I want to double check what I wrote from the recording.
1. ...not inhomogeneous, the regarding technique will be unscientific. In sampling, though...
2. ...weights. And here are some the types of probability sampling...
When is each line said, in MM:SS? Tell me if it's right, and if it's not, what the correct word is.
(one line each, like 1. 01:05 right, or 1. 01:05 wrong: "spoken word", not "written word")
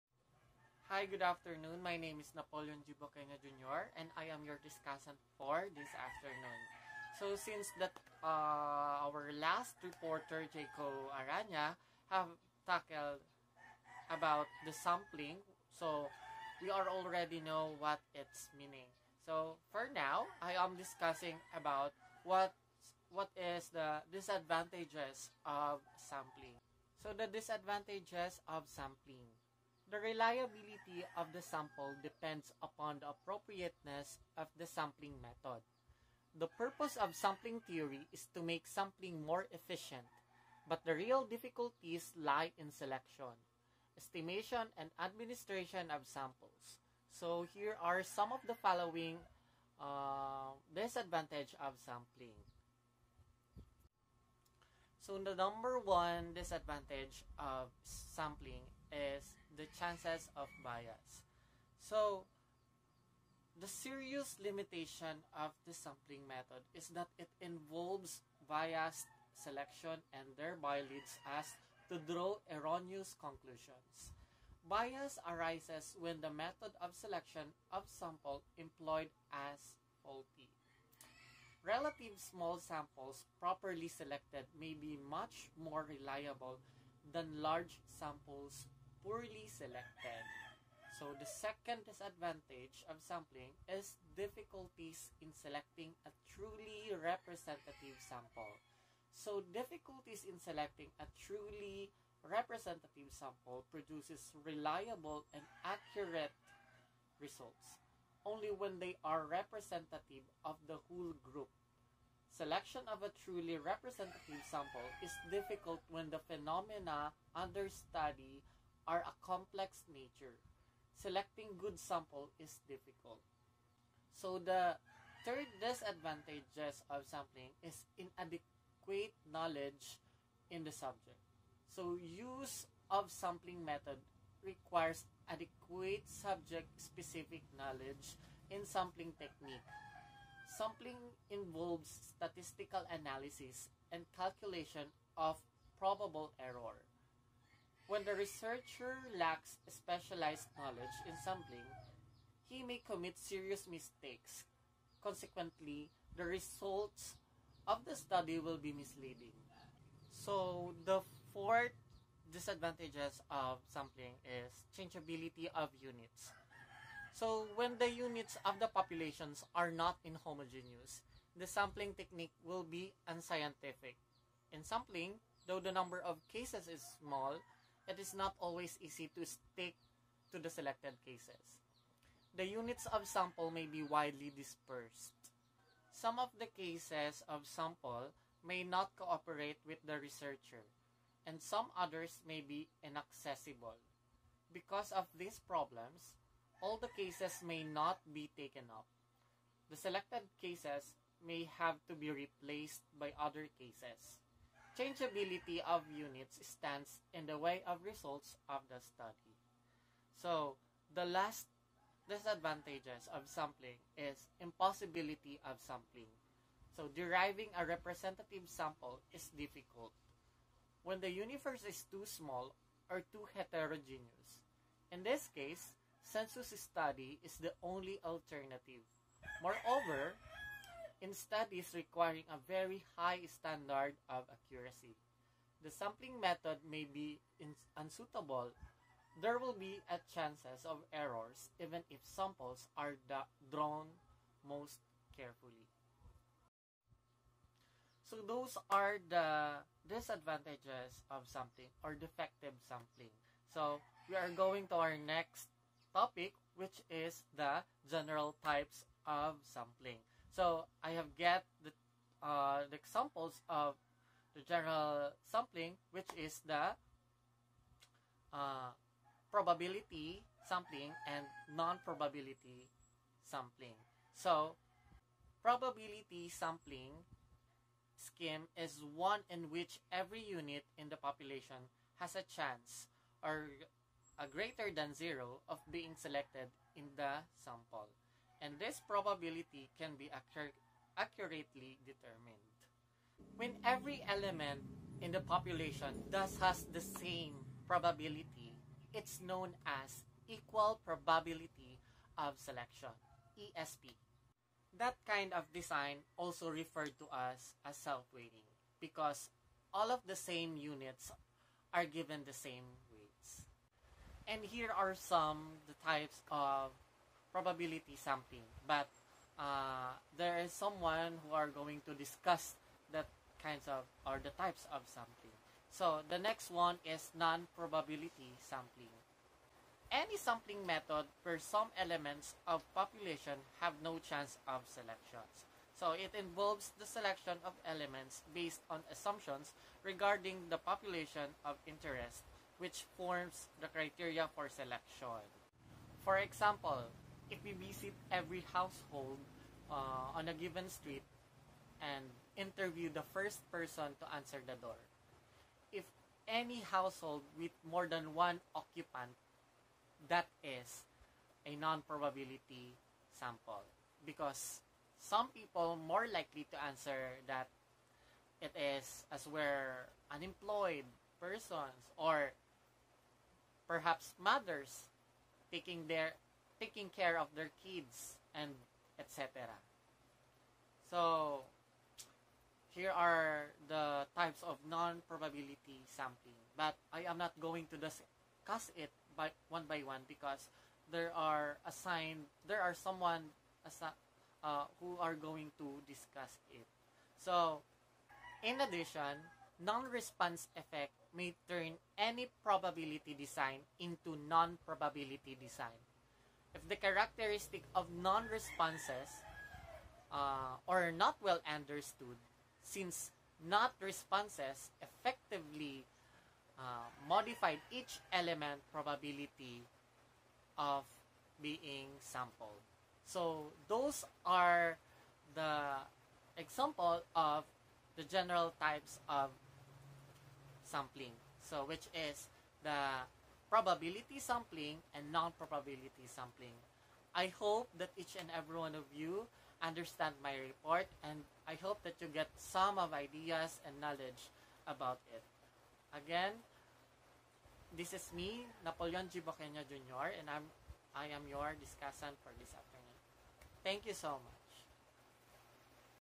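1. 02:49 wrong: "sampling", not "regarding"
2. 05:12 right.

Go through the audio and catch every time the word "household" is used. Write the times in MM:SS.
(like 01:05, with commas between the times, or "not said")
05:48, 05:56.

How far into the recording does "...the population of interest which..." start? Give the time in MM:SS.
05:40.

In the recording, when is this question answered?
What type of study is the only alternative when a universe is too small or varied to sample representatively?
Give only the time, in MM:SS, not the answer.
03:46.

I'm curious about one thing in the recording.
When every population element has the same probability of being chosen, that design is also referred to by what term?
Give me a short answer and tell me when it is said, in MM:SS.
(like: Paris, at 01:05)
Self-weighting, at 05:07.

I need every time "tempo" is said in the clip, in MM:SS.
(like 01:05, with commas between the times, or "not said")
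not said.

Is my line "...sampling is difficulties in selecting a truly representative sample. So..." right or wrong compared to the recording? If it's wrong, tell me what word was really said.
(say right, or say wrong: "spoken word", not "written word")
right.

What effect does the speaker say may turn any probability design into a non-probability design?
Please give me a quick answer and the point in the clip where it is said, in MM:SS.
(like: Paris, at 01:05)
Non-response effect, at 06:39.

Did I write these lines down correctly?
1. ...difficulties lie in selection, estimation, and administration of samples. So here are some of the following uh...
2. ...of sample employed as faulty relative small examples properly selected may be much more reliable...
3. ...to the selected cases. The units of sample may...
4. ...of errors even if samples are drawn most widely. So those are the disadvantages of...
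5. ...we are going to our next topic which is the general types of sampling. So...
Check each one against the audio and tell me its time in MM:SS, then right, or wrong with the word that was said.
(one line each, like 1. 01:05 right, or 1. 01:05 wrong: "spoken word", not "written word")
1. 00:41 right
2. 01:17 wrong: "samples", not "examples"
3. 03:00 right
4. 04:00 wrong: "carefully", not "widely"
5. 04:14 right.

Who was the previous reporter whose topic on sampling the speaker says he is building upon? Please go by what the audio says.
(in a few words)
Jaco Aranya.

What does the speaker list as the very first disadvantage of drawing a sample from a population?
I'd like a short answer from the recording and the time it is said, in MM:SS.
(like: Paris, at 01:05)
Chances of bias, at 00:59.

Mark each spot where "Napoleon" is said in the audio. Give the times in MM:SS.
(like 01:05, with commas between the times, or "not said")
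00:02, 07:28.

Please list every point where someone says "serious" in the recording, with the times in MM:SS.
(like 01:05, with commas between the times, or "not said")
01:03, 02:33.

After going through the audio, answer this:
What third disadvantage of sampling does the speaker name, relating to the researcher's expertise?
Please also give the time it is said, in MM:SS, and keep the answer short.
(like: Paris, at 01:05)
Inadequate knowledge in the subject, at 02:07.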